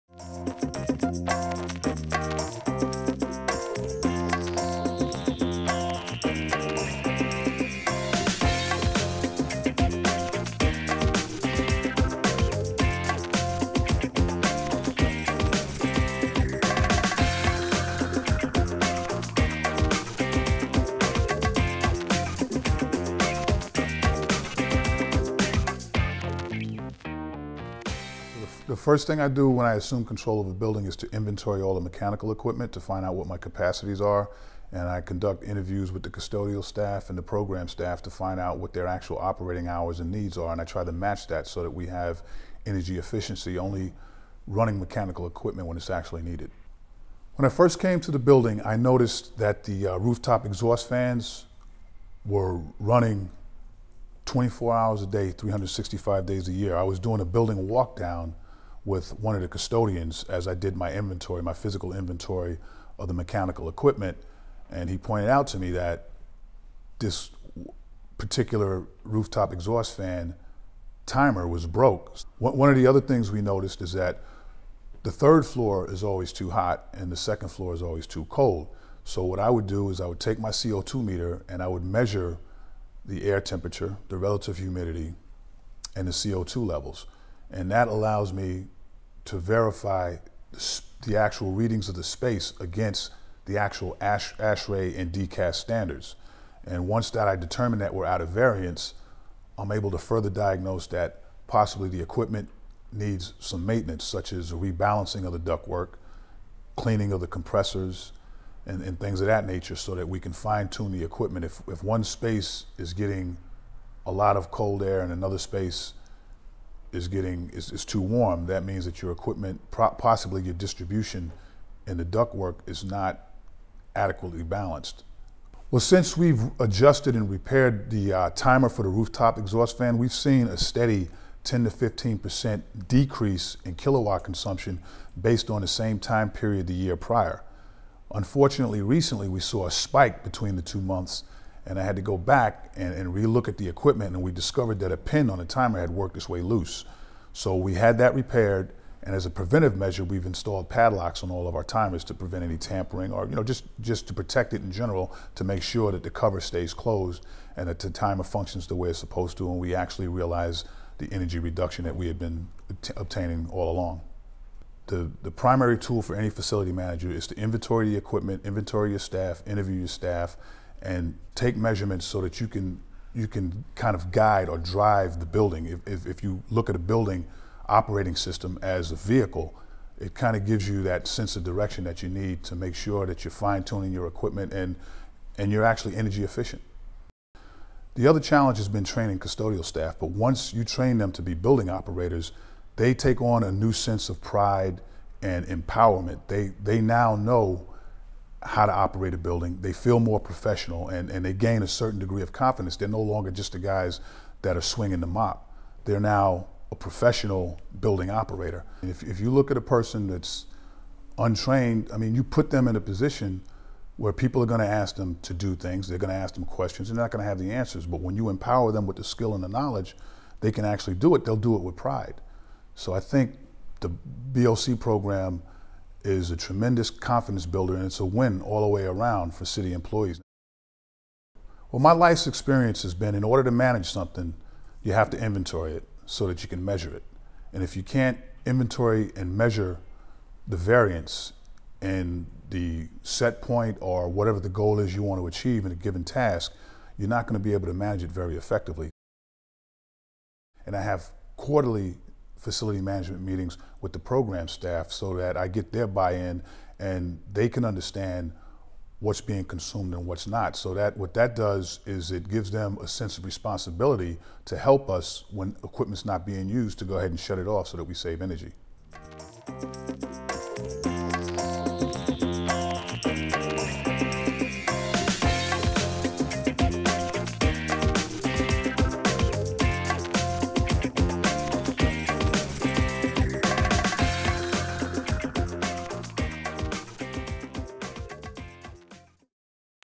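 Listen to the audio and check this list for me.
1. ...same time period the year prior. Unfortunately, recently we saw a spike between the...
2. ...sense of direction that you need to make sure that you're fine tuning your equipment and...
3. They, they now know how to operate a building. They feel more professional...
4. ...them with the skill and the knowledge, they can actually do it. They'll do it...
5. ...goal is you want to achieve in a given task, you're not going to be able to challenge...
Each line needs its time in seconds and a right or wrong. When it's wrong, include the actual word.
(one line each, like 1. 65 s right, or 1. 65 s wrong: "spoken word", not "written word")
1. 135 s right
2. 181 s right
3. 196 s right
4. 218 s right
5. 244 s wrong: "manage", not "challenge".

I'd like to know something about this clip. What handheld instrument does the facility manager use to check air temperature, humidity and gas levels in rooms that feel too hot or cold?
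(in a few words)
CO2 meter.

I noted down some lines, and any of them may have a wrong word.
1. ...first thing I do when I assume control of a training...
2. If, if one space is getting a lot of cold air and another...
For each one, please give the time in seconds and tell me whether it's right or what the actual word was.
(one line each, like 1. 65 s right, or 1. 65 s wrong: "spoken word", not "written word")
1. 28 s wrong: "building", not "training"
2. 111 s right.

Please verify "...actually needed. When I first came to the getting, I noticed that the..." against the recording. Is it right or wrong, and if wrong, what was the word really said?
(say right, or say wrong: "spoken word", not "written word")
wrong: "building", not "getting".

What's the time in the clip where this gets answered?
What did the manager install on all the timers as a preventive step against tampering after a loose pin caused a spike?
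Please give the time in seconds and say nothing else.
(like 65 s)
150 s.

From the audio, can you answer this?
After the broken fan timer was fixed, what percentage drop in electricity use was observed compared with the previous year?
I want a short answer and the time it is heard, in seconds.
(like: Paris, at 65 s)
10 to 15%, at 131 s.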